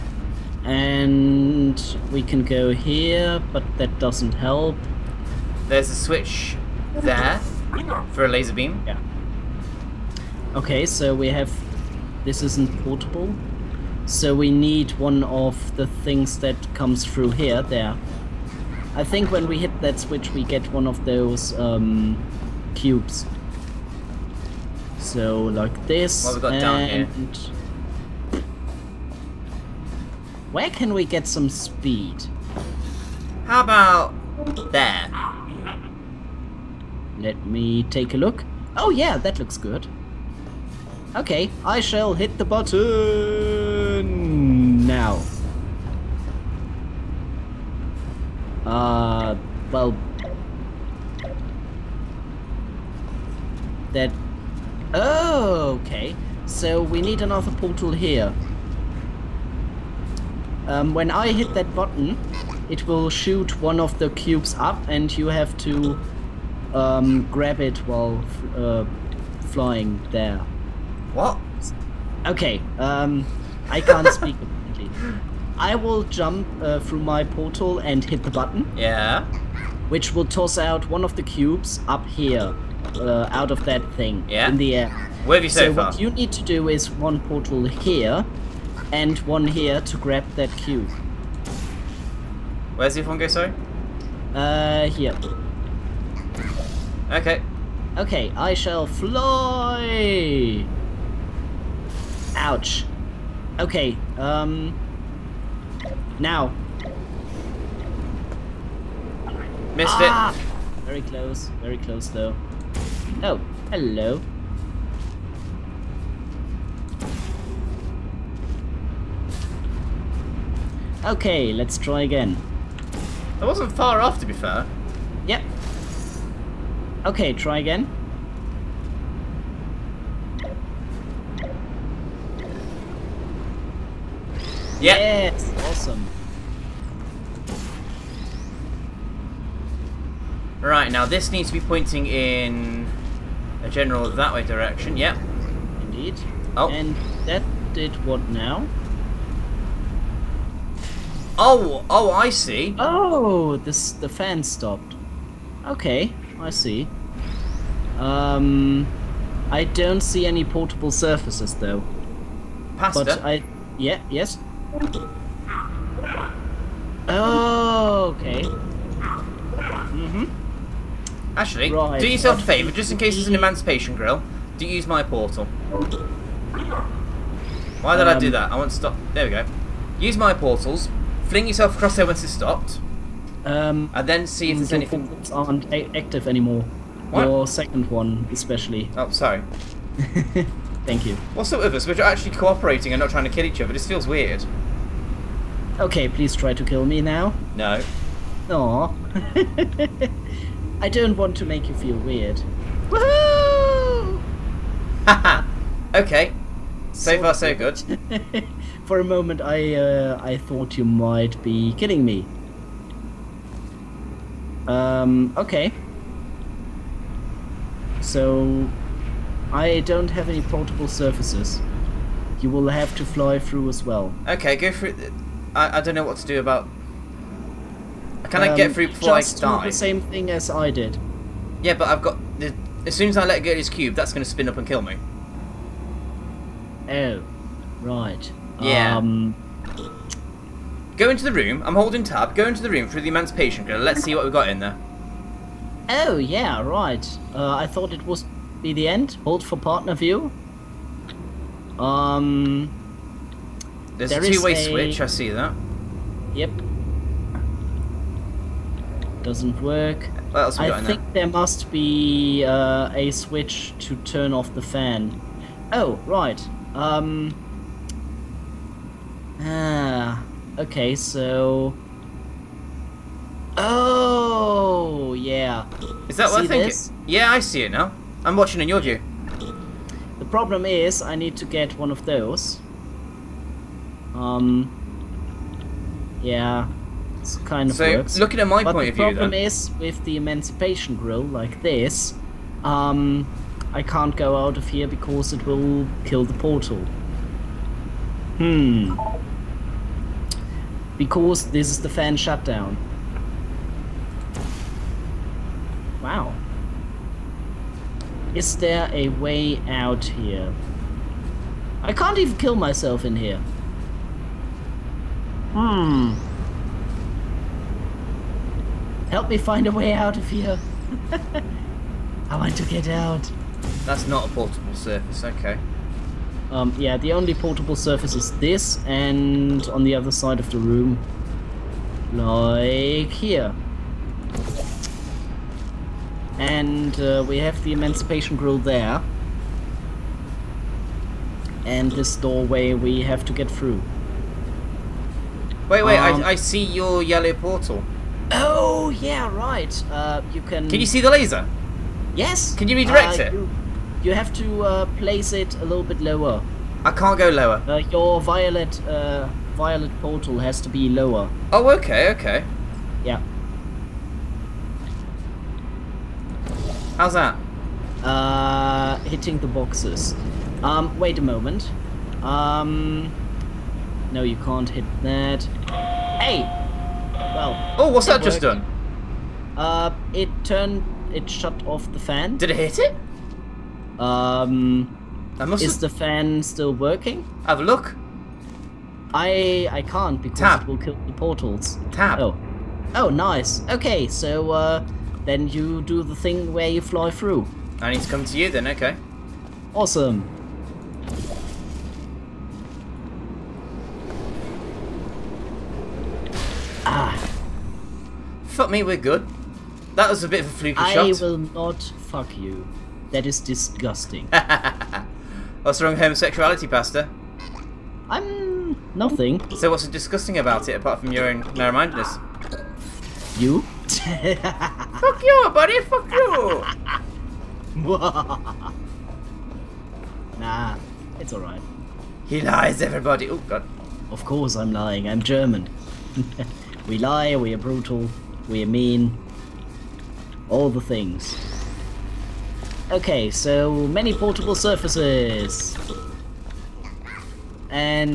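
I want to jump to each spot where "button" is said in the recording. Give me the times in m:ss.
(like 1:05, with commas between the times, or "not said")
0:42, 1:01, 1:18.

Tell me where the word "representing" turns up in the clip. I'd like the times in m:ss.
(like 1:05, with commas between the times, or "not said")
not said.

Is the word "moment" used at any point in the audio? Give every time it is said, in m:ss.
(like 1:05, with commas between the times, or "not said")
3:29, 6:11.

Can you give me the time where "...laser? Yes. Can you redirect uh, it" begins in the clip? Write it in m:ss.
5:51.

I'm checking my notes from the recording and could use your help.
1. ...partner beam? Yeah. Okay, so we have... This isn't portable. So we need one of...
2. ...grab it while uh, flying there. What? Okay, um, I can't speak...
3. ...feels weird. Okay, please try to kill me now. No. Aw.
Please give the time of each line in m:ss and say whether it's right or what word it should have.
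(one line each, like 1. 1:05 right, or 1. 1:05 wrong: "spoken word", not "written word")
1. 0:08 wrong: "laser", not "partner"
2. 1:07 right
3. 3:13 right.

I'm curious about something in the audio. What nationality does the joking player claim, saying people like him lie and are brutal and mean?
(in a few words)
German.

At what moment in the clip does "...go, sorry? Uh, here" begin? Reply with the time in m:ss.
1:33.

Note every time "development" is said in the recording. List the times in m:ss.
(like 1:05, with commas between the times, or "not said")
not said.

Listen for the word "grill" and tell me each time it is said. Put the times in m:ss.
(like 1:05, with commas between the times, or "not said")
2:53, 4:03, 4:50, 5:38.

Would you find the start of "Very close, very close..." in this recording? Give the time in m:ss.
1:50.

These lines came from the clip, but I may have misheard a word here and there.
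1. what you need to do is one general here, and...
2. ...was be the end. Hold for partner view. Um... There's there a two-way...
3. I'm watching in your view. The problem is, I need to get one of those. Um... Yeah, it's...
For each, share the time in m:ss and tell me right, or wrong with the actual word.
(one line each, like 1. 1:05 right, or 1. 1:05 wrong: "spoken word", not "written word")
1. 1:25 wrong: "portal", not "general"
2. 4:08 right
3. 4:38 right.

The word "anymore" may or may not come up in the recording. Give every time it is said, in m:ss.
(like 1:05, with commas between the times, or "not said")
3:06.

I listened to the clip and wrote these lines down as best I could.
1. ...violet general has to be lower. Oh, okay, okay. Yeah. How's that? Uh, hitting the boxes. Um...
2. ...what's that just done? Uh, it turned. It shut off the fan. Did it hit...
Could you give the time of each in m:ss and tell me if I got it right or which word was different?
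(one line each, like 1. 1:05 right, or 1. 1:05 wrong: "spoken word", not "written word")
1. 5:59 wrong: "portal", not "general"
2. 6:17 right.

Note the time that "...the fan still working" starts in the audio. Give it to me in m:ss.
6:25.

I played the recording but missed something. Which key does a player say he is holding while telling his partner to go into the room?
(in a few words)
tab.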